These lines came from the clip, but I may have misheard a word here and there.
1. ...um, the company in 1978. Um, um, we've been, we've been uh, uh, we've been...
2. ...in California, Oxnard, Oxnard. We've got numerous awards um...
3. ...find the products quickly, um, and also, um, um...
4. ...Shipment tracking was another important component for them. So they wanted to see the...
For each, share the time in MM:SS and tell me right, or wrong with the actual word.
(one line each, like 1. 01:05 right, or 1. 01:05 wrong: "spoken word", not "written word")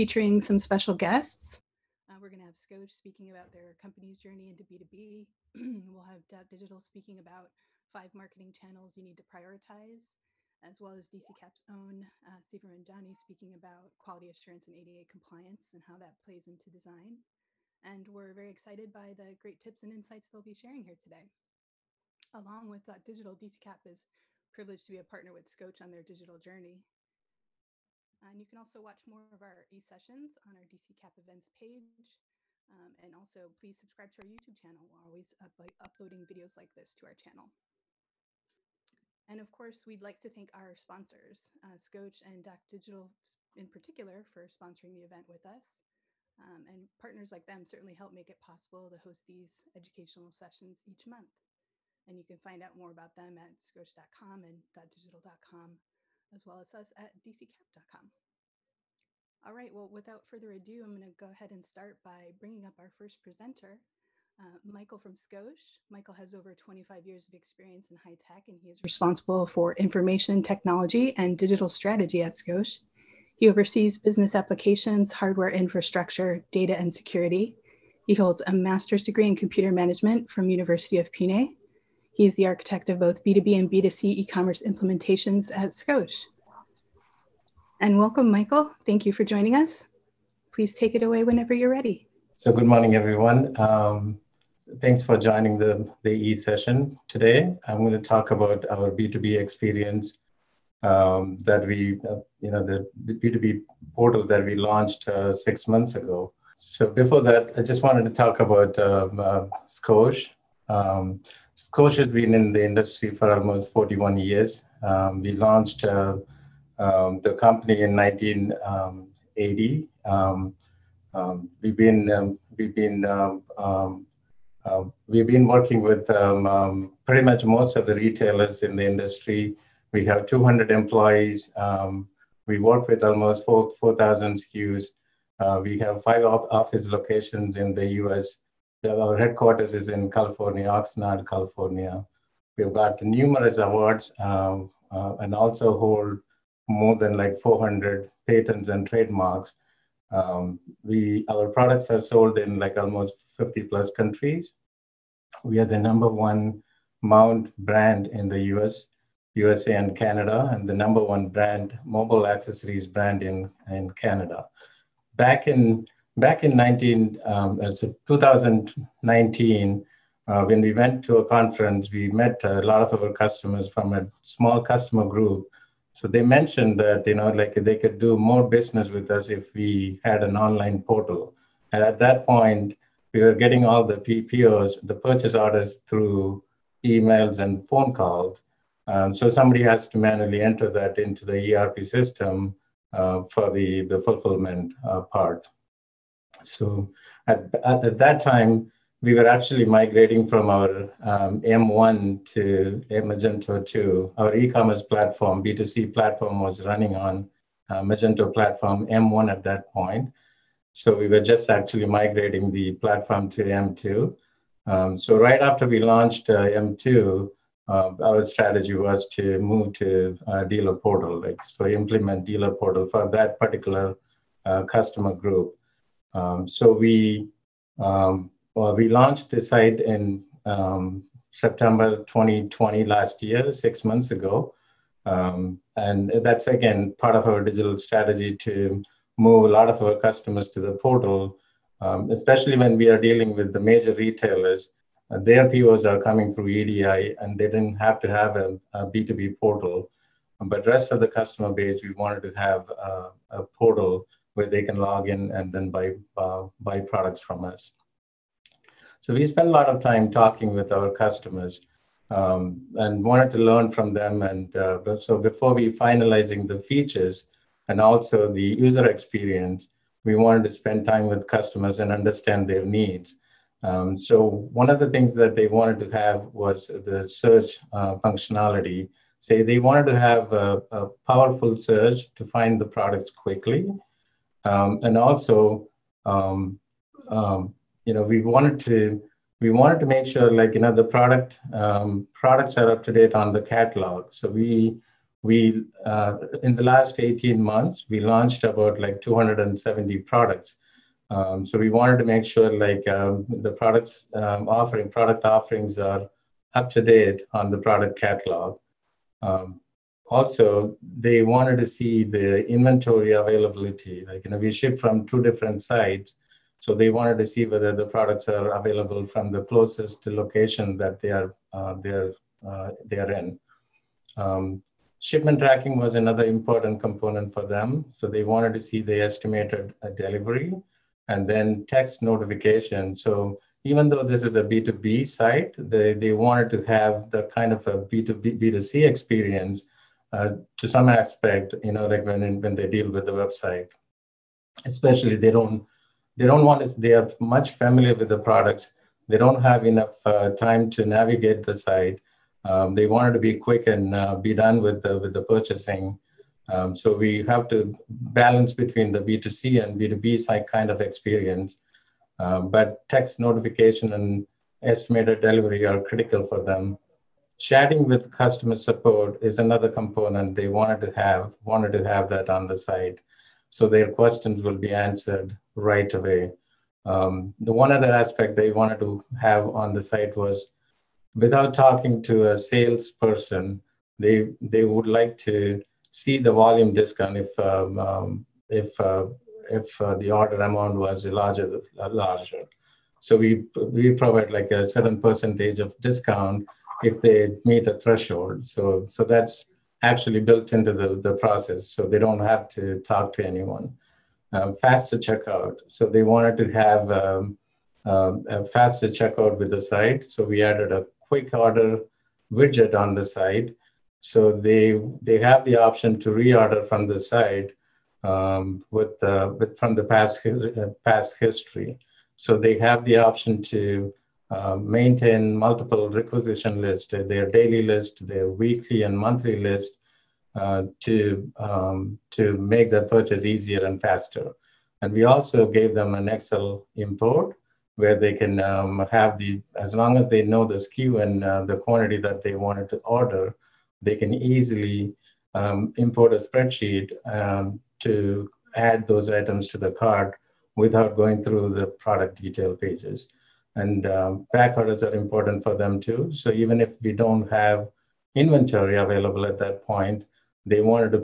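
1. 01:56 wrong: "1980", not "1978"
2. 02:19 wrong: "California", not "Oxnard"
3. 04:42 right
4. 05:24 right.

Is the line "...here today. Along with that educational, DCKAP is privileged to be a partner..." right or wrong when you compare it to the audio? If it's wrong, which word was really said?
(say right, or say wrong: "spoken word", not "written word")
wrong: "digital", not "educational".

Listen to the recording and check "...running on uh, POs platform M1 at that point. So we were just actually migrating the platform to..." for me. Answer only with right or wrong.
wrong.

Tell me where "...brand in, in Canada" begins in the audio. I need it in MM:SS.
02:42.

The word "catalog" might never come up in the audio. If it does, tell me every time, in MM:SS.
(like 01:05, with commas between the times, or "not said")
04:53, 05:07.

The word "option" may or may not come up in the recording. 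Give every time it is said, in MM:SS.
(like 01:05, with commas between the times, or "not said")
06:55, 07:02.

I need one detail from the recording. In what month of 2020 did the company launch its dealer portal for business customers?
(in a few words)
September.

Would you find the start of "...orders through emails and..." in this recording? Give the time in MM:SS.
03:05.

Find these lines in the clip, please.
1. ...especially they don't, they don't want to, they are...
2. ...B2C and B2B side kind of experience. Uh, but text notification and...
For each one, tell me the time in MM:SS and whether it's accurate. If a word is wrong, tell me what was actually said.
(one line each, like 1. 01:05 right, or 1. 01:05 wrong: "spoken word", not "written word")
1. 05:44 right
2. 05:58 right.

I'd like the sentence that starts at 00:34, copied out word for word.
We're always up uploading videos like this to our channel.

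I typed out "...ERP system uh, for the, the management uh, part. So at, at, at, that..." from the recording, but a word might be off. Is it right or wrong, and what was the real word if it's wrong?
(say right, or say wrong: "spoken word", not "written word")
wrong: "fulfillment", not "management".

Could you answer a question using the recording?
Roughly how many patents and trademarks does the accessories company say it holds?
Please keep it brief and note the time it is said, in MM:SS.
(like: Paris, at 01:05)
400, at 02:27.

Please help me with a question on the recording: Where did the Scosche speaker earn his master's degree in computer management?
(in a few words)
University of Pune.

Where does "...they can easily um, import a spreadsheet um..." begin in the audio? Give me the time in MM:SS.
07:23.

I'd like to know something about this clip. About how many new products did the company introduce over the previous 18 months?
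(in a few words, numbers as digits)
270.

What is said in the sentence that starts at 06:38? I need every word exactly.
So so that's actually built into the, the process.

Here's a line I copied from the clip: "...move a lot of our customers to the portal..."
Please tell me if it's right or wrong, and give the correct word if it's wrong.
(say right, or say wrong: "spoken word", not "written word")
right.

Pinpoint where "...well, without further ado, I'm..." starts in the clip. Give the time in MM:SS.
00:59.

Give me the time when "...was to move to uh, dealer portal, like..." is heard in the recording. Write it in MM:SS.
03:38.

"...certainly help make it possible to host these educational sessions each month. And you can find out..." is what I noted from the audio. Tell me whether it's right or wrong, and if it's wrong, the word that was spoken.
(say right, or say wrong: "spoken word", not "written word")
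right.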